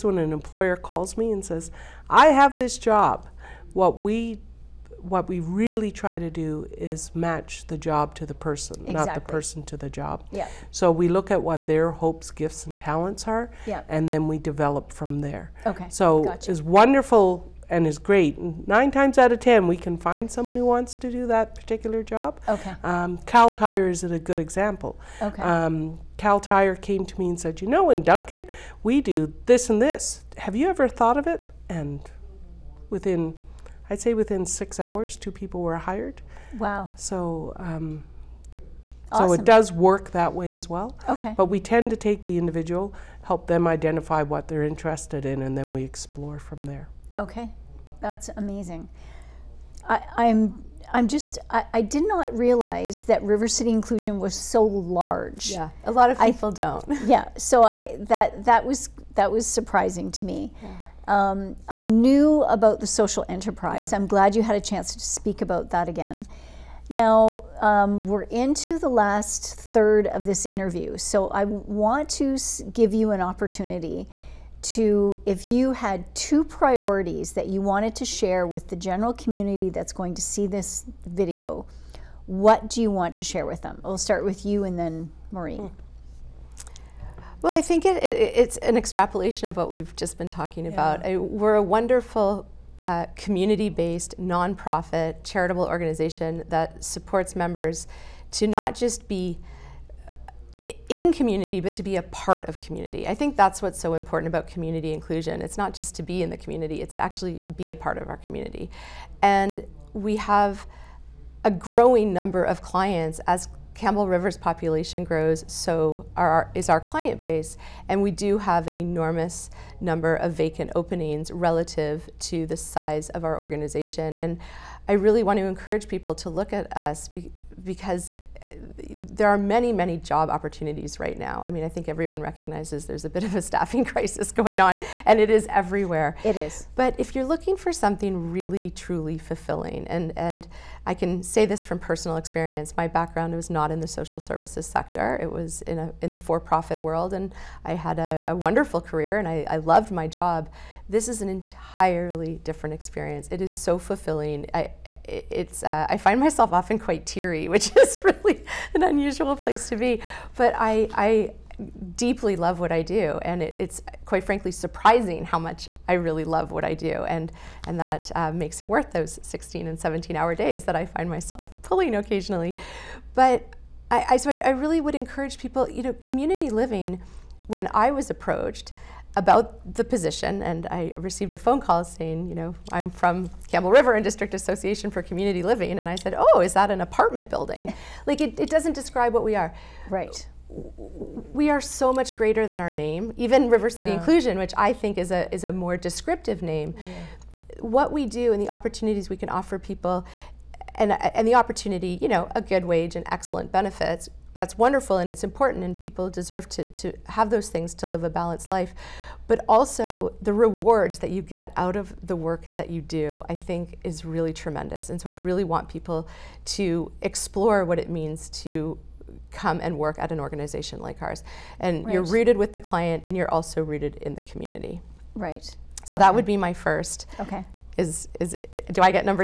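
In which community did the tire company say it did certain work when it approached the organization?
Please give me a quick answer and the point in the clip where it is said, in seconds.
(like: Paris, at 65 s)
Duncan, at 28 s.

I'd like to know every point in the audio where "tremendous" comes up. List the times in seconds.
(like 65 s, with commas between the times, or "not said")
214 s.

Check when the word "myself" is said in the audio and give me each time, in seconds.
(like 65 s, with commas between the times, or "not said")
156 s, 171 s.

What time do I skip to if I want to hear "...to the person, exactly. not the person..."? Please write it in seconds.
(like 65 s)
8 s.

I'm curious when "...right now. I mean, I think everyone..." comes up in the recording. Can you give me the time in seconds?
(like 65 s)
131 s.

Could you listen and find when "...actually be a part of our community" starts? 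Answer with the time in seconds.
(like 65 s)
107 s.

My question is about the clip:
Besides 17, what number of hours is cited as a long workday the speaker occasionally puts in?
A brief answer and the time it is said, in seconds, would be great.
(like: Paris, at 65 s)
16, at 169 s.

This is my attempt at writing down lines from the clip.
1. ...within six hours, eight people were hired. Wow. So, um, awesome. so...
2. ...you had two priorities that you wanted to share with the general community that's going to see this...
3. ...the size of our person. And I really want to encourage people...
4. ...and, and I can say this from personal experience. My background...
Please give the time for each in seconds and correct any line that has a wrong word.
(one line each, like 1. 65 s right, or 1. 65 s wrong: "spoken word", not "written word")
1. 34 s wrong: "two", not "eight"
2. 75 s right
3. 122 s wrong: "organization", not "person"
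4. 139 s right.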